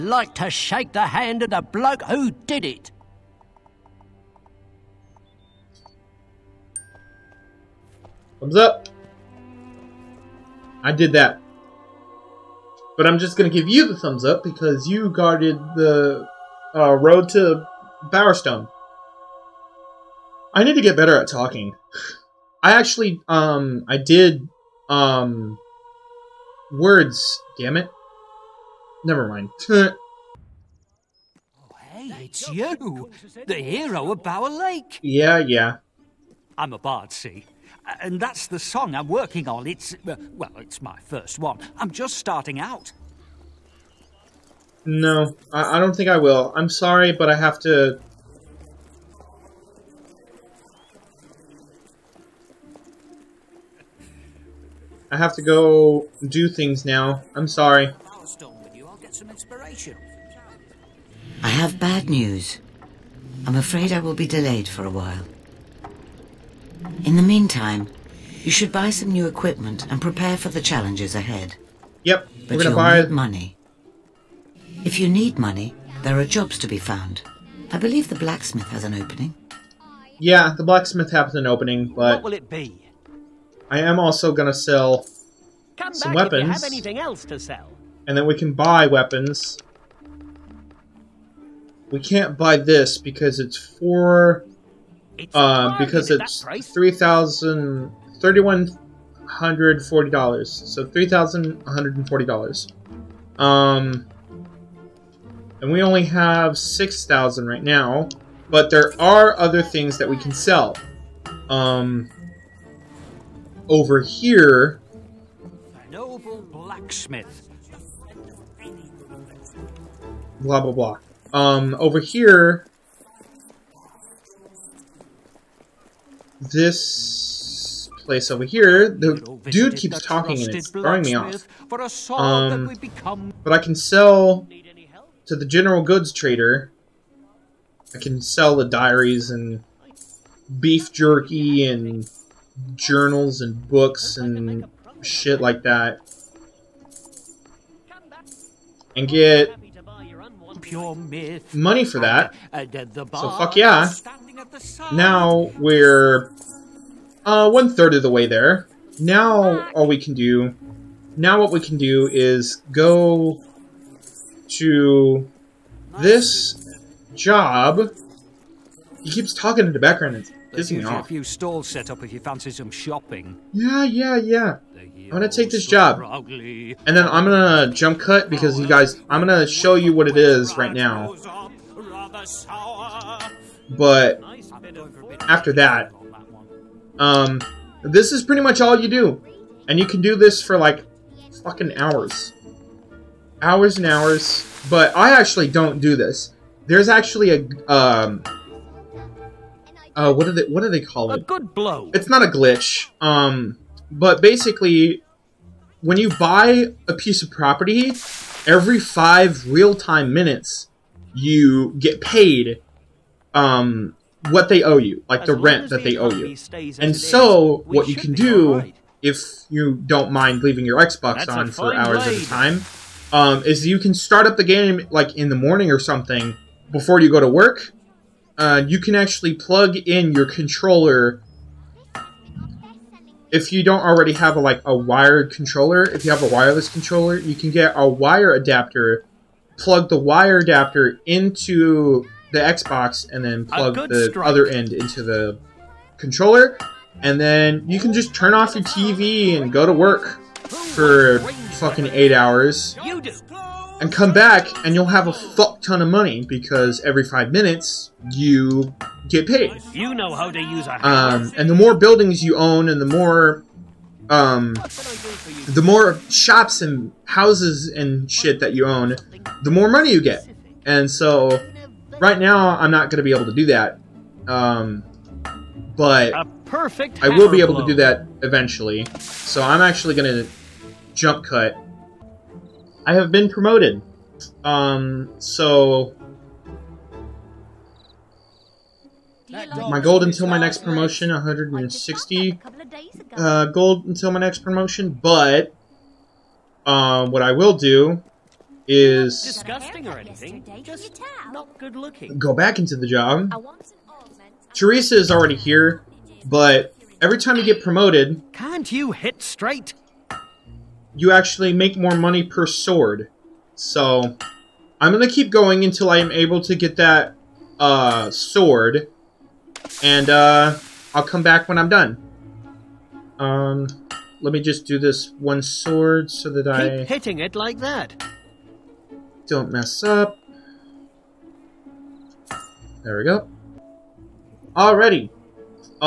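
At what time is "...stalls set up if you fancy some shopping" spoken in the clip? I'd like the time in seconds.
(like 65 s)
171 s.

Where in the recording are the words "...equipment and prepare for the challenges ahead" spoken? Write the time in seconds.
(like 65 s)
69 s.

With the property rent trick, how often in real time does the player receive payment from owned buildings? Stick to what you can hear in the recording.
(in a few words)
Every 5 minutes.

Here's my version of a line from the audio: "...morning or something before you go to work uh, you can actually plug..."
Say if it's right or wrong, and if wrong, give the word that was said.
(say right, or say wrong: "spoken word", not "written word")
right.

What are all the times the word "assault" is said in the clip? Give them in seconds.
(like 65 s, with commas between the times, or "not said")
not said.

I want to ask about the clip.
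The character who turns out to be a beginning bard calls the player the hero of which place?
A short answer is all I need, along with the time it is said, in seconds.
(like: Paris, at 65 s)
Bower Lake, at 34 s.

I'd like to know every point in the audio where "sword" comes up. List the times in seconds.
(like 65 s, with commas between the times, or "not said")
312 s, 318 s, 325 s.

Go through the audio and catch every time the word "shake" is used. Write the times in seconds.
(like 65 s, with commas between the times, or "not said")
0 s.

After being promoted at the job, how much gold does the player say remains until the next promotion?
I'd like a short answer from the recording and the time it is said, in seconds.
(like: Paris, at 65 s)
160, at 291 s.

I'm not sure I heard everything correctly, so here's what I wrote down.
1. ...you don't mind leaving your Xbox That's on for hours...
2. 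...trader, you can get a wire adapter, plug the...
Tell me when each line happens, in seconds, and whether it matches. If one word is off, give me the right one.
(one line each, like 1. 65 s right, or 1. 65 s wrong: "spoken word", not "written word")
1. 219 s right
2. 236 s wrong: "controller", not "trader".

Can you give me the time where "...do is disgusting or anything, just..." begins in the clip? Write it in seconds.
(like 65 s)
297 s.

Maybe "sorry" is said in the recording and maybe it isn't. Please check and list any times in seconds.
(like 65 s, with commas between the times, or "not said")
46 s, 57 s.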